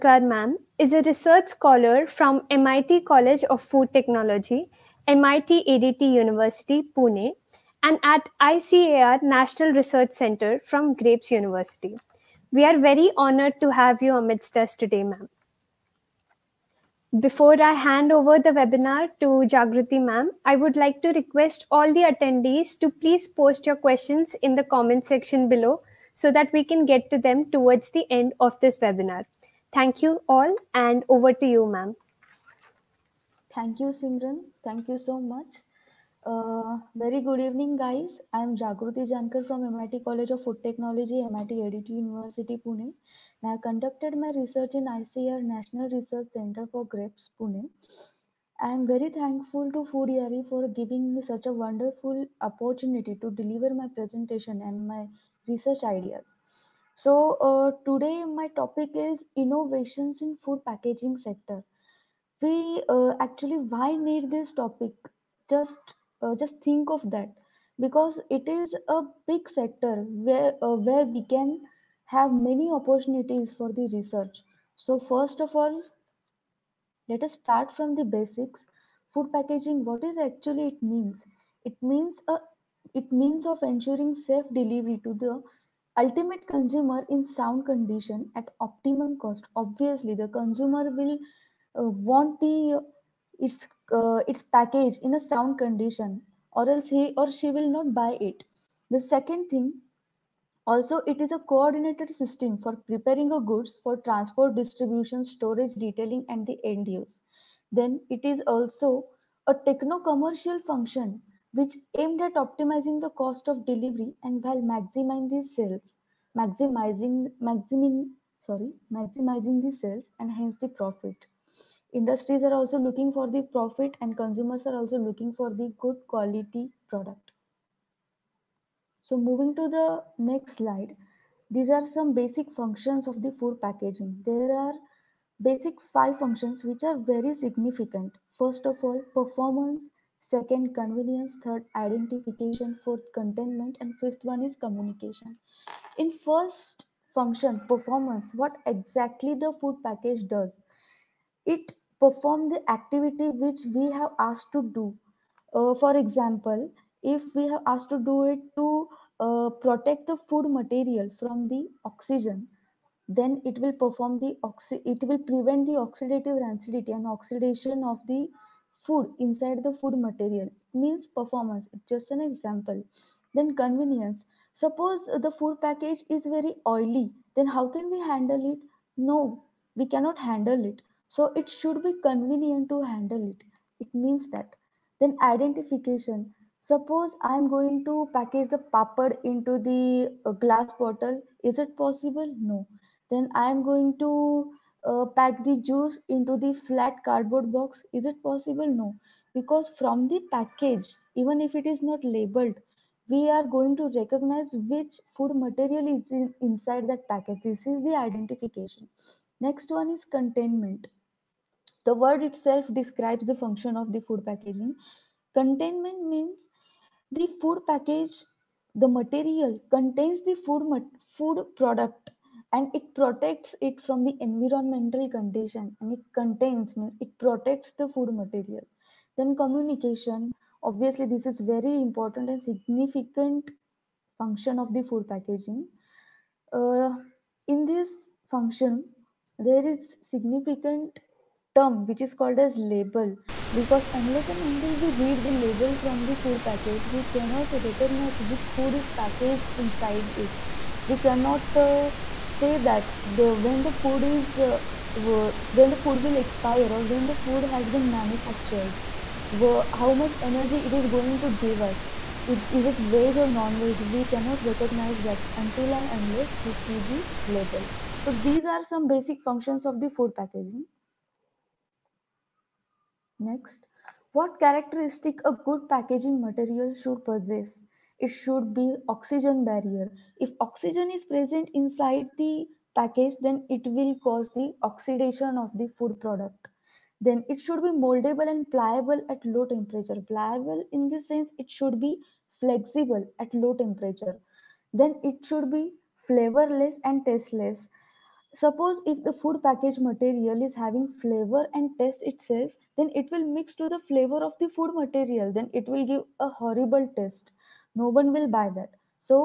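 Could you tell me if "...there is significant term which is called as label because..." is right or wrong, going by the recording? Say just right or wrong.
right.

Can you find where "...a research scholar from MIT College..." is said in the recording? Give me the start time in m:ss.
0:00.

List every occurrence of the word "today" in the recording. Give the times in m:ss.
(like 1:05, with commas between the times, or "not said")
0:14, 0:57.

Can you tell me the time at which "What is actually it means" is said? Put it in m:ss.
1:19.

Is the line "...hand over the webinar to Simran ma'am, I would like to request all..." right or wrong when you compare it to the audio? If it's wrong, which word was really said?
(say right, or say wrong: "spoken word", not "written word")
wrong: "Jagruti", not "Simran".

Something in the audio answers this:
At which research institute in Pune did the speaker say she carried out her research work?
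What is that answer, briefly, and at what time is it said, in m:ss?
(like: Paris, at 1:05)
ICAR National Research Center for Grapes, at 0:44.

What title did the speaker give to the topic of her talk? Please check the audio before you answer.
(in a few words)
Innovations in food packaging sector.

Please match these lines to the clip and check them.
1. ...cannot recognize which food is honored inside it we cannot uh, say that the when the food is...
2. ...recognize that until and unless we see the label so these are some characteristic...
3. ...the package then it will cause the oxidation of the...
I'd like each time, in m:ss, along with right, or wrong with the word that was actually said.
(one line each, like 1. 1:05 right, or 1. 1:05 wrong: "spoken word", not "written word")
1. 4:07 wrong: "packaged", not "honored"
2. 4:24 wrong: "basic", not "characteristic"
3. 4:42 right.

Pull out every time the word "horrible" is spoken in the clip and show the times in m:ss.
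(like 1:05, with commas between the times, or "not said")
5:06.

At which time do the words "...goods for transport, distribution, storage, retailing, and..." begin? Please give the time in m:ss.
1:43.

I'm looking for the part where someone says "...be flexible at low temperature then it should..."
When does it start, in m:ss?
4:51.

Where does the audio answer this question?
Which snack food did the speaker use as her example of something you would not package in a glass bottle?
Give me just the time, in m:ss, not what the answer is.
3:08.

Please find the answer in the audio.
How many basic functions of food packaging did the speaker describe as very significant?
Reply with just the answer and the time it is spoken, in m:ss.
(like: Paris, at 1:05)
5, at 2:15.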